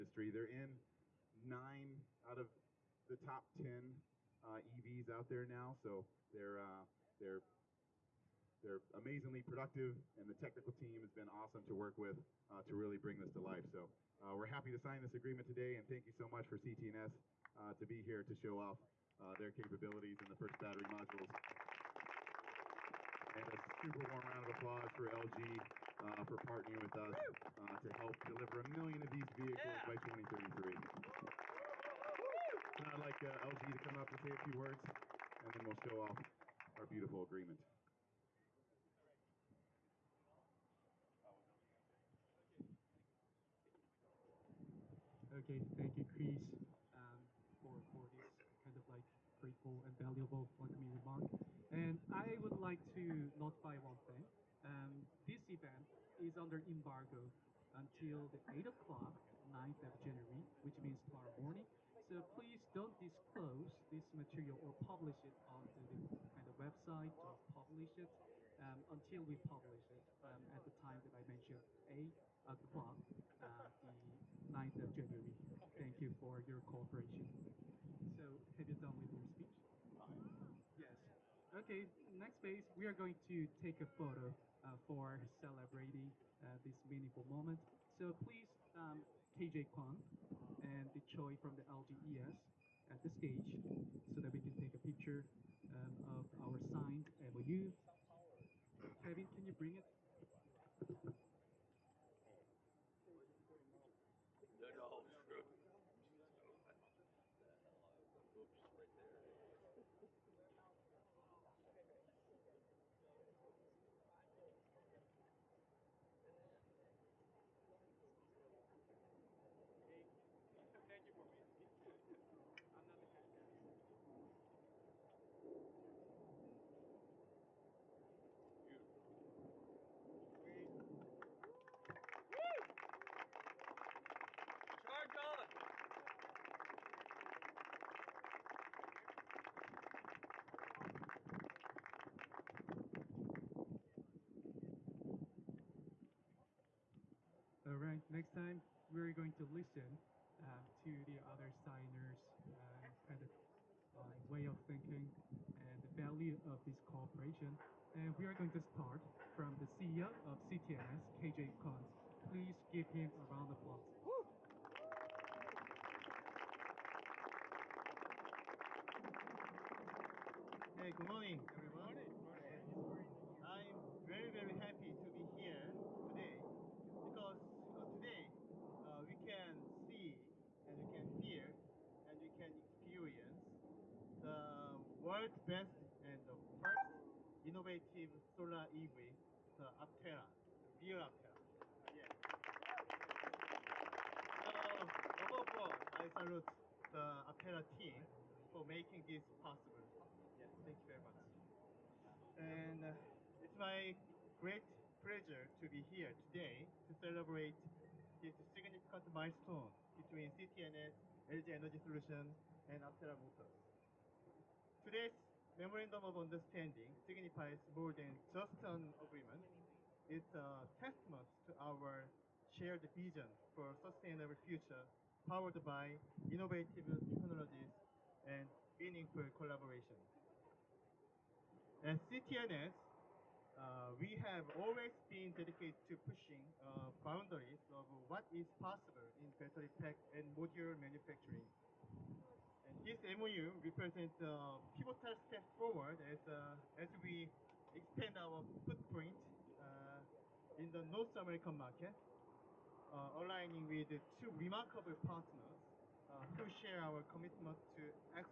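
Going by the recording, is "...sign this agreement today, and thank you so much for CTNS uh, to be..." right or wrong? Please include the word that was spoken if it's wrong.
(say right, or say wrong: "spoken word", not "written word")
right.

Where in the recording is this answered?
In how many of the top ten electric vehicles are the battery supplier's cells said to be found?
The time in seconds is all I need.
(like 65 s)
1 s.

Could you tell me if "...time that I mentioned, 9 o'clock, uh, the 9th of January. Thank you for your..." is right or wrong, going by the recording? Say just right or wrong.
wrong.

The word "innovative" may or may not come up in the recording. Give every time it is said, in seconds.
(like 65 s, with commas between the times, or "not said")
187 s, 226 s.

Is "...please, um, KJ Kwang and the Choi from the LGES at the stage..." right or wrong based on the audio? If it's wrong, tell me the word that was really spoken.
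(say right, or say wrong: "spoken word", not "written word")
right.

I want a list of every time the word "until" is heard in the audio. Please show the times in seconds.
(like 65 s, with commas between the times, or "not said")
57 s, 68 s.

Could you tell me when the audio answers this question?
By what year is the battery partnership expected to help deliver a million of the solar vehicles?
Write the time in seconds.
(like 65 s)
29 s.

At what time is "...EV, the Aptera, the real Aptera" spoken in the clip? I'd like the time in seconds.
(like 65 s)
188 s.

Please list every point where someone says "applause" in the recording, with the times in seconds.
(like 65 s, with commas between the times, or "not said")
24 s, 163 s.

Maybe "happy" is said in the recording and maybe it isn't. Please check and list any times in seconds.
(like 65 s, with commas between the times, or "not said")
14 s, 174 s.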